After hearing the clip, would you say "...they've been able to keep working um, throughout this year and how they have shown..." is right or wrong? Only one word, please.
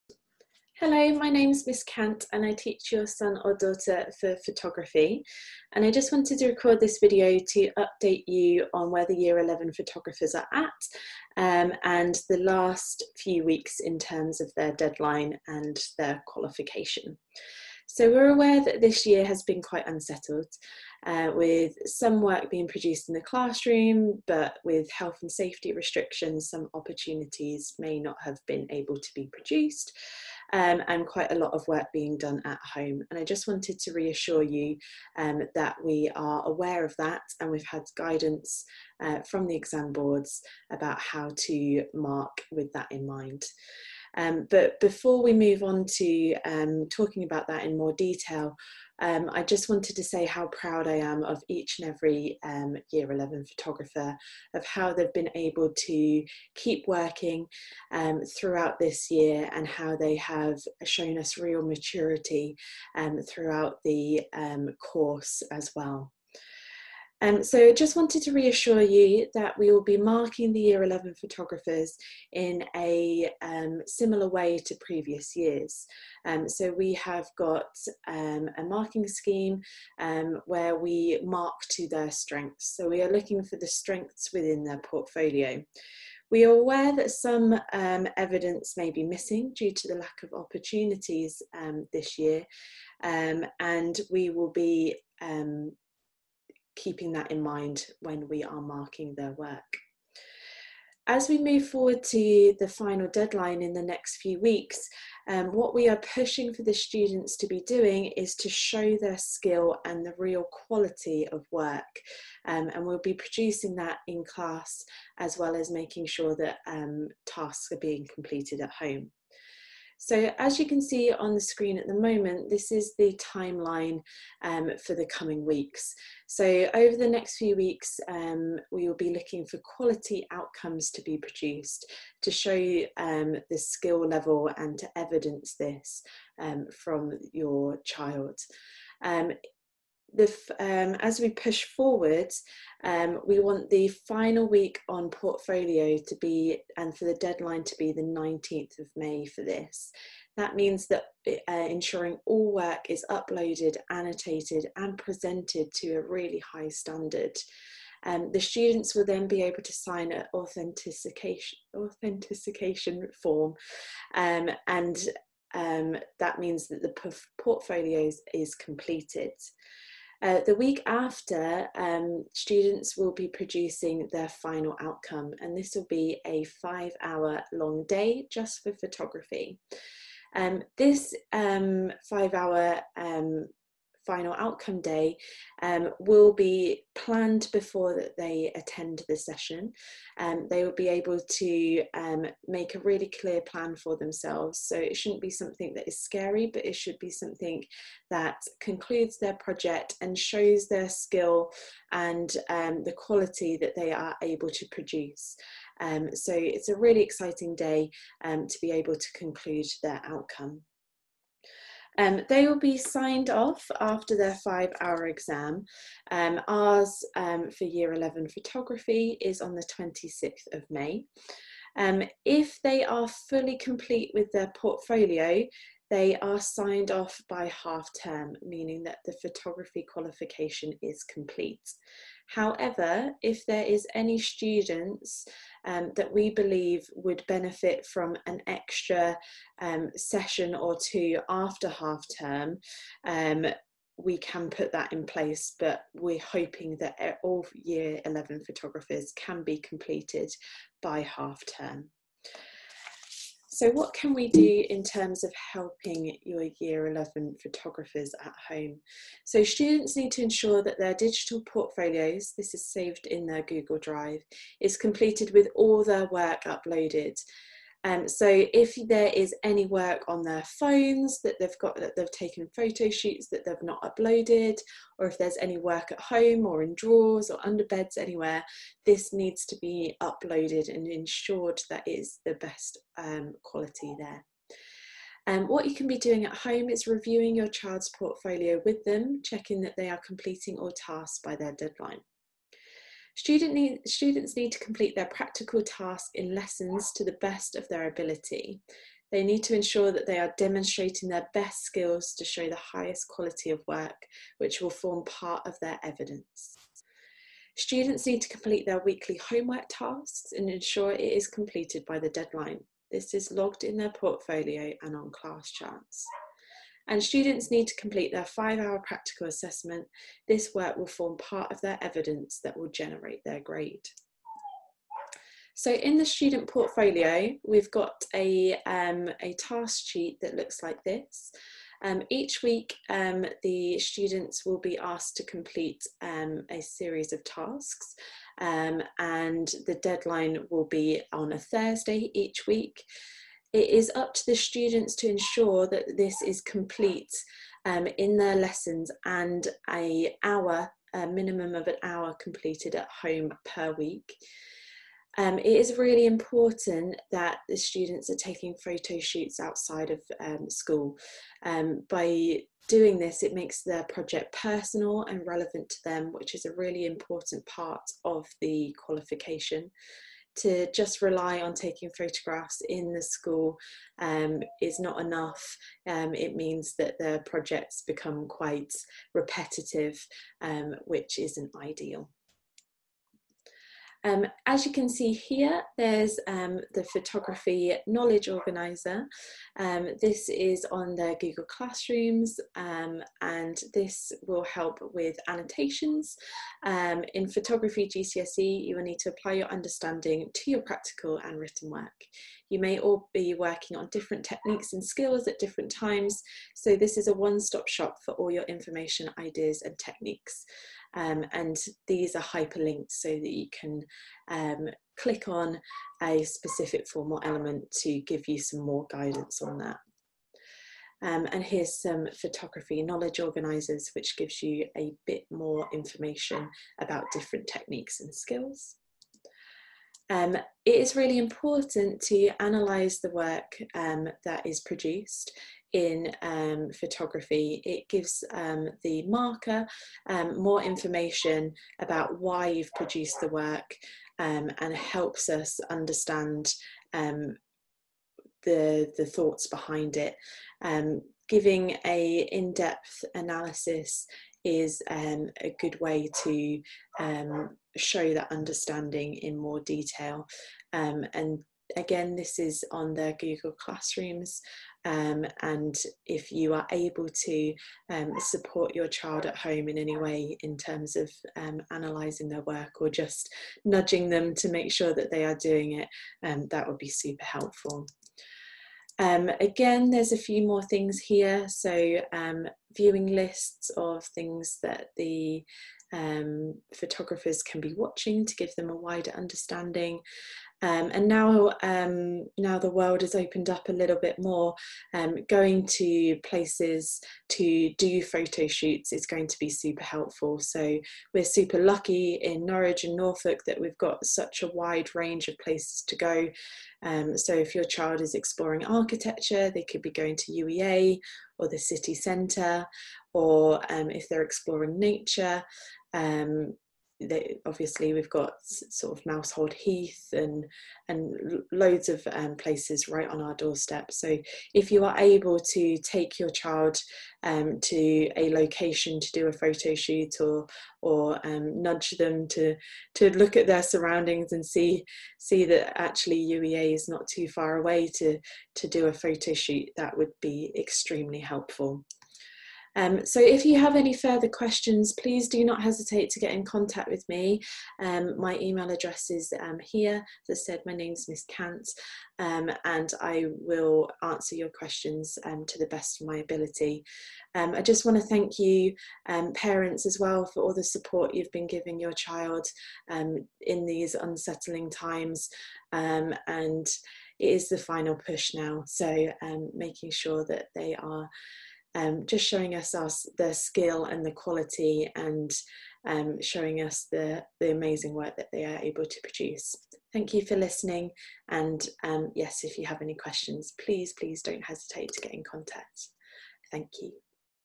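right.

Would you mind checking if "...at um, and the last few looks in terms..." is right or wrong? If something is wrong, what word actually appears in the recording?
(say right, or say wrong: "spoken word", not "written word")
wrong: "weeks", not "looks".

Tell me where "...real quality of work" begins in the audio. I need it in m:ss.
1:50.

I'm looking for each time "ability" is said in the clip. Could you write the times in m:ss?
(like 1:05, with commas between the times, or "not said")
4:57, 9:16.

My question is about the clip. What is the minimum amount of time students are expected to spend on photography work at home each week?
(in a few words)
an hour.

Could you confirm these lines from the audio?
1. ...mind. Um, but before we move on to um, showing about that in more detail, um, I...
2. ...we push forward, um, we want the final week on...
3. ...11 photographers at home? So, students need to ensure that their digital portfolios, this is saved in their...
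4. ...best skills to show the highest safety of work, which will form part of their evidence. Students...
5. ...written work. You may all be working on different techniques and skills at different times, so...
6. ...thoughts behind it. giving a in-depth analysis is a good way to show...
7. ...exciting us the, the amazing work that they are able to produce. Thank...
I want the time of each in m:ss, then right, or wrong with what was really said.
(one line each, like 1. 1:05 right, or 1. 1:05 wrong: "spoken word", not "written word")
1. 0:43 wrong: "talking", not "showing"
2. 2:21 right
3. 4:16 right
4. 5:01 wrong: "quality", not "safety"
5. 6:41 right
6. 7:29 right
7. 9:36 wrong: "showing", not "exciting".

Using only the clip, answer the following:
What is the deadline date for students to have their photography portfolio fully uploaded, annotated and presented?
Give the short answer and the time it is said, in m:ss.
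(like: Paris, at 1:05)
19th of May, at 2:28.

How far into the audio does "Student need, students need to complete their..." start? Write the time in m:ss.
4:53.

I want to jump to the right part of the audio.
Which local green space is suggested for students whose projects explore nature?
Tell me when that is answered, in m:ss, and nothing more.
8:39.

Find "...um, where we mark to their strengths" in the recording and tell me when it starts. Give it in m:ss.
1:19.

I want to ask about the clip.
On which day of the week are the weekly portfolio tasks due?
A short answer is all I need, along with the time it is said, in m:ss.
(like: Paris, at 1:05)
Thursday, at 5:41.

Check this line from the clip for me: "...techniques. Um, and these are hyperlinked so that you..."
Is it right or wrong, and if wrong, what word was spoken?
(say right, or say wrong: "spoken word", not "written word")
right.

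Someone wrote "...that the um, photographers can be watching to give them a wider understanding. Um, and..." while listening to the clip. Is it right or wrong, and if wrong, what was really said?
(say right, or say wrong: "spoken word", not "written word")
right.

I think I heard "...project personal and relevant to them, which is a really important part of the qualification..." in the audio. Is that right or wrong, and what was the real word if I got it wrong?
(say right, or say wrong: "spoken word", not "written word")
right.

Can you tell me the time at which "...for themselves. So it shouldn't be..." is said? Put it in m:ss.
3:13.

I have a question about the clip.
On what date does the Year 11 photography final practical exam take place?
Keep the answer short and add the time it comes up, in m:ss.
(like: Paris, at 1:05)
26th of May, at 3:39.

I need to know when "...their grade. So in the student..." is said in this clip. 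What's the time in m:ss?
5:23.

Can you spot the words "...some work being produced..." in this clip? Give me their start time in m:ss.
0:21.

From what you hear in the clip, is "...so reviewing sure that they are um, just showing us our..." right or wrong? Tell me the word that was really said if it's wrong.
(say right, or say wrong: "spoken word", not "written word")
wrong: "making", not "reviewing".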